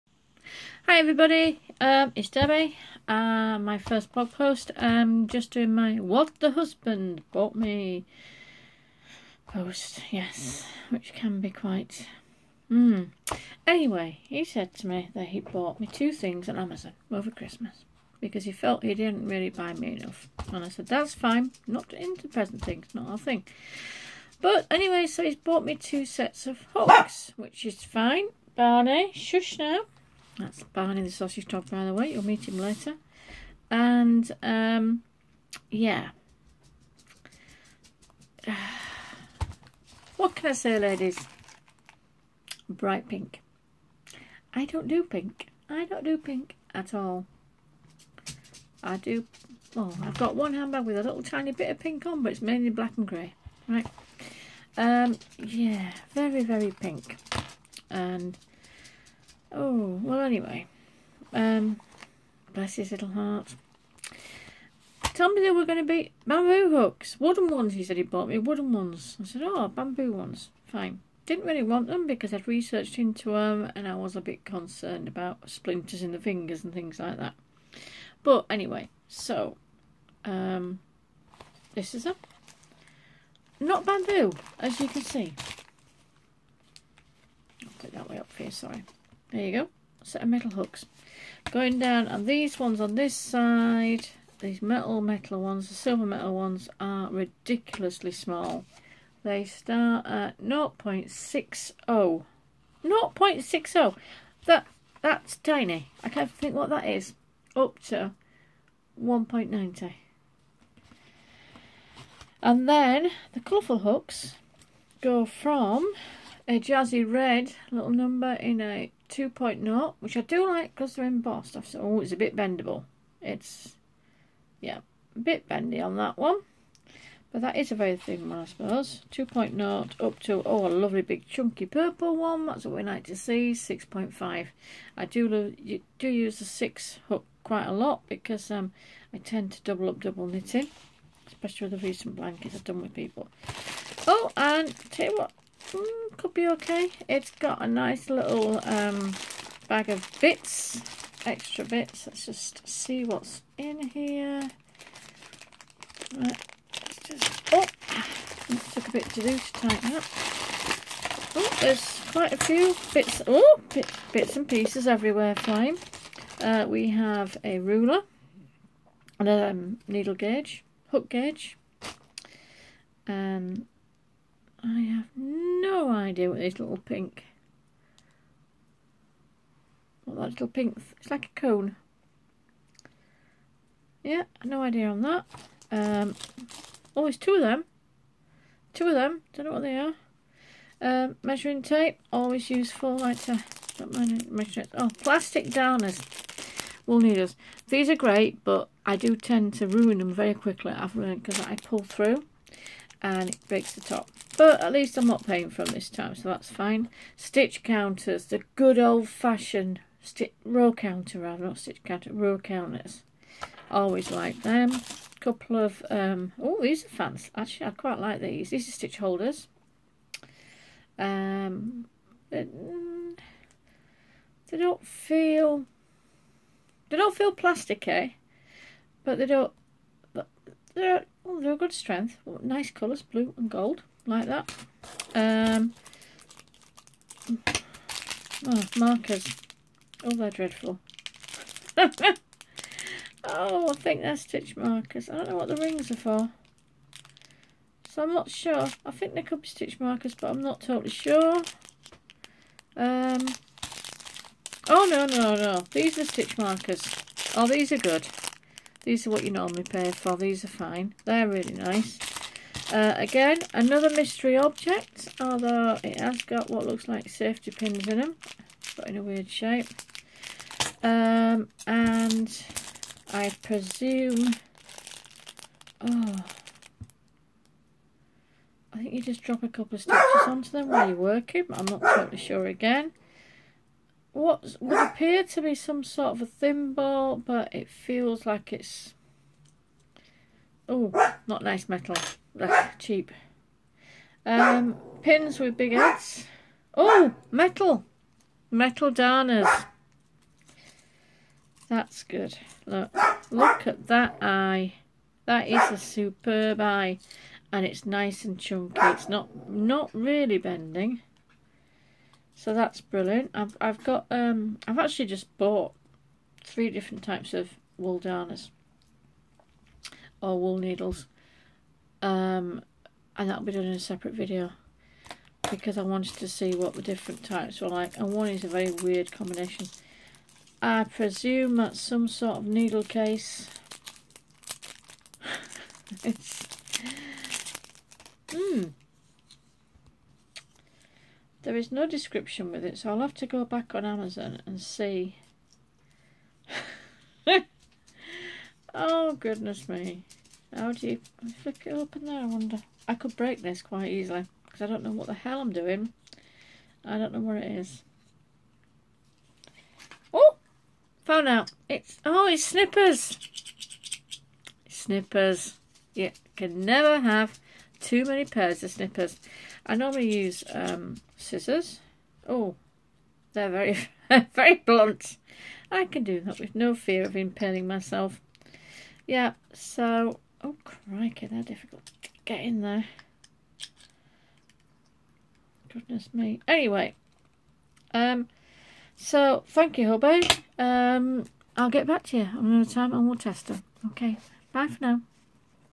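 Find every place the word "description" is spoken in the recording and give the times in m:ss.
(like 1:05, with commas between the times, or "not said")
5:41.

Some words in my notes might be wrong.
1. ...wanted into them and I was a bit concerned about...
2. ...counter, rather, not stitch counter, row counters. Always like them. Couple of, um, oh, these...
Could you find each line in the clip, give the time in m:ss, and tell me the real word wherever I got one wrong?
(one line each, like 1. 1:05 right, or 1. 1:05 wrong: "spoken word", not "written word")
1. 1:12 wrong: "researched", not "wanted"
2. 3:30 right.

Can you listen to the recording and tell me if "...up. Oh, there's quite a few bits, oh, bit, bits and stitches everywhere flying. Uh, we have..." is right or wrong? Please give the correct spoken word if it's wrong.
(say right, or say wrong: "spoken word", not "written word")
wrong: "pieces", not "stitches".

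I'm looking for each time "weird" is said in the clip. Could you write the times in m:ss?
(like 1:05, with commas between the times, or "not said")
4:29, 5:28.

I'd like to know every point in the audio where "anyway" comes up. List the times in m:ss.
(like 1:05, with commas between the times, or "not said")
0:13, 0:24, 1:00, 1:18, 6:26.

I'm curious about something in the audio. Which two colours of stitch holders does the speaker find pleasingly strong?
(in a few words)
Blue and gold.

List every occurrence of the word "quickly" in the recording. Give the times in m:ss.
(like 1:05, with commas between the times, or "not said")
3:20.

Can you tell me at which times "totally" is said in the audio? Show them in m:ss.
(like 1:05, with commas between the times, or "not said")
4:10, 4:41.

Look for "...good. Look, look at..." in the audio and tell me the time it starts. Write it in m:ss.
5:02.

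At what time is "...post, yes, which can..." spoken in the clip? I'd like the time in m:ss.
0:09.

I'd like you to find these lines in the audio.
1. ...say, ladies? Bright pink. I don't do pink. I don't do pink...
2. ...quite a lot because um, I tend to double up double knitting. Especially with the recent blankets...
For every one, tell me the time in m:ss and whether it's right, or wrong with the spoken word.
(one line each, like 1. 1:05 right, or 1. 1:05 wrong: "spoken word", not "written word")
1. 0:40 right
2. 2:17 right.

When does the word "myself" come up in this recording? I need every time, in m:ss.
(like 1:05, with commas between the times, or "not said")
6:17.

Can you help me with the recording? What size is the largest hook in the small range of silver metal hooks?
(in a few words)
1.90.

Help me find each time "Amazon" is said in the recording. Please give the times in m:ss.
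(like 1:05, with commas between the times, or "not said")
0:16, 5:43.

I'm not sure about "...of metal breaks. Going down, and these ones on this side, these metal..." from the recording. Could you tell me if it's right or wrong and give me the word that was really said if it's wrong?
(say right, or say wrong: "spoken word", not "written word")
wrong: "hooks", not "breaks".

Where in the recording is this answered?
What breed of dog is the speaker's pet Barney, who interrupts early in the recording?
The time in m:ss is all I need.
0:31.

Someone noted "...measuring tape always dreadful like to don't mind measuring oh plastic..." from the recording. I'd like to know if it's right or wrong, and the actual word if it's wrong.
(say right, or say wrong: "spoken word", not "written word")
wrong: "useful", not "dreadful".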